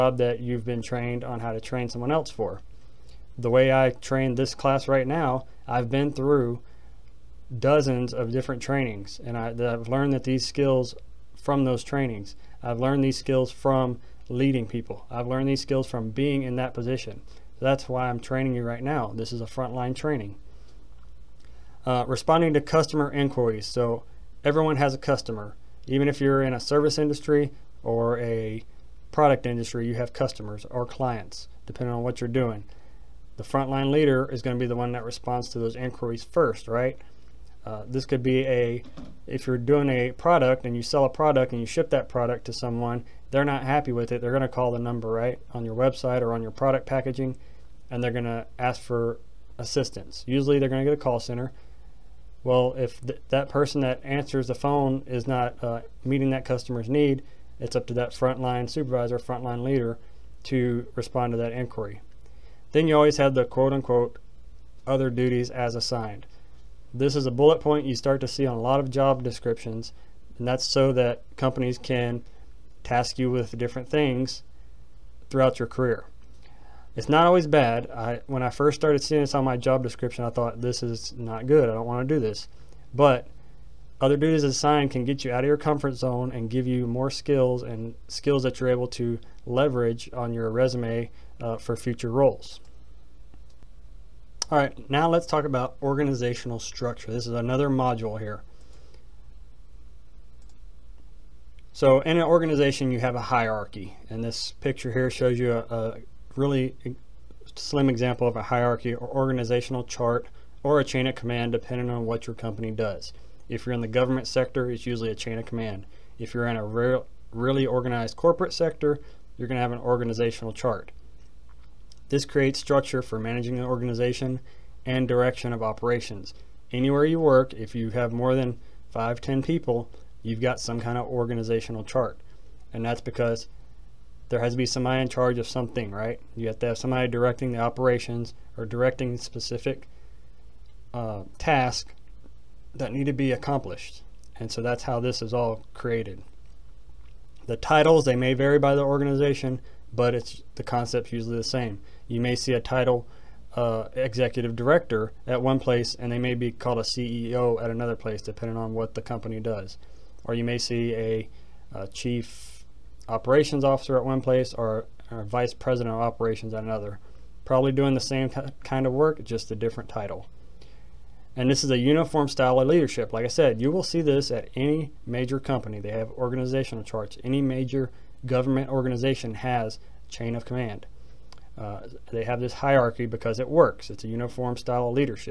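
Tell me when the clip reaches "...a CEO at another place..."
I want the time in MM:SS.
02:36.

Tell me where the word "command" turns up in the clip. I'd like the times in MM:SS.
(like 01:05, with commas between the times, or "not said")
01:51, 01:55, 03:00.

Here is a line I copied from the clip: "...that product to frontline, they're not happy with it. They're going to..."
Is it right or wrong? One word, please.
wrong.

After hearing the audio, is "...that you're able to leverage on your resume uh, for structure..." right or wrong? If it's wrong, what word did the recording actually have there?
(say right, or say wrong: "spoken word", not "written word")
wrong: "future", not "structure".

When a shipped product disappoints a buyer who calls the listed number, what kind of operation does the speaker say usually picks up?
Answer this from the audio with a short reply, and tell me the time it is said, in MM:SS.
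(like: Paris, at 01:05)
A call center, at 00:51.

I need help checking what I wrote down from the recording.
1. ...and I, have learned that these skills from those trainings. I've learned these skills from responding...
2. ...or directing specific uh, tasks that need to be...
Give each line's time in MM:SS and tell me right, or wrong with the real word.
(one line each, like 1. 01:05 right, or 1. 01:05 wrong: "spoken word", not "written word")
1. 00:09 wrong: "leading", not "responding"
2. 02:18 right.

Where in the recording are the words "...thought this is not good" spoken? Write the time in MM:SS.
01:20.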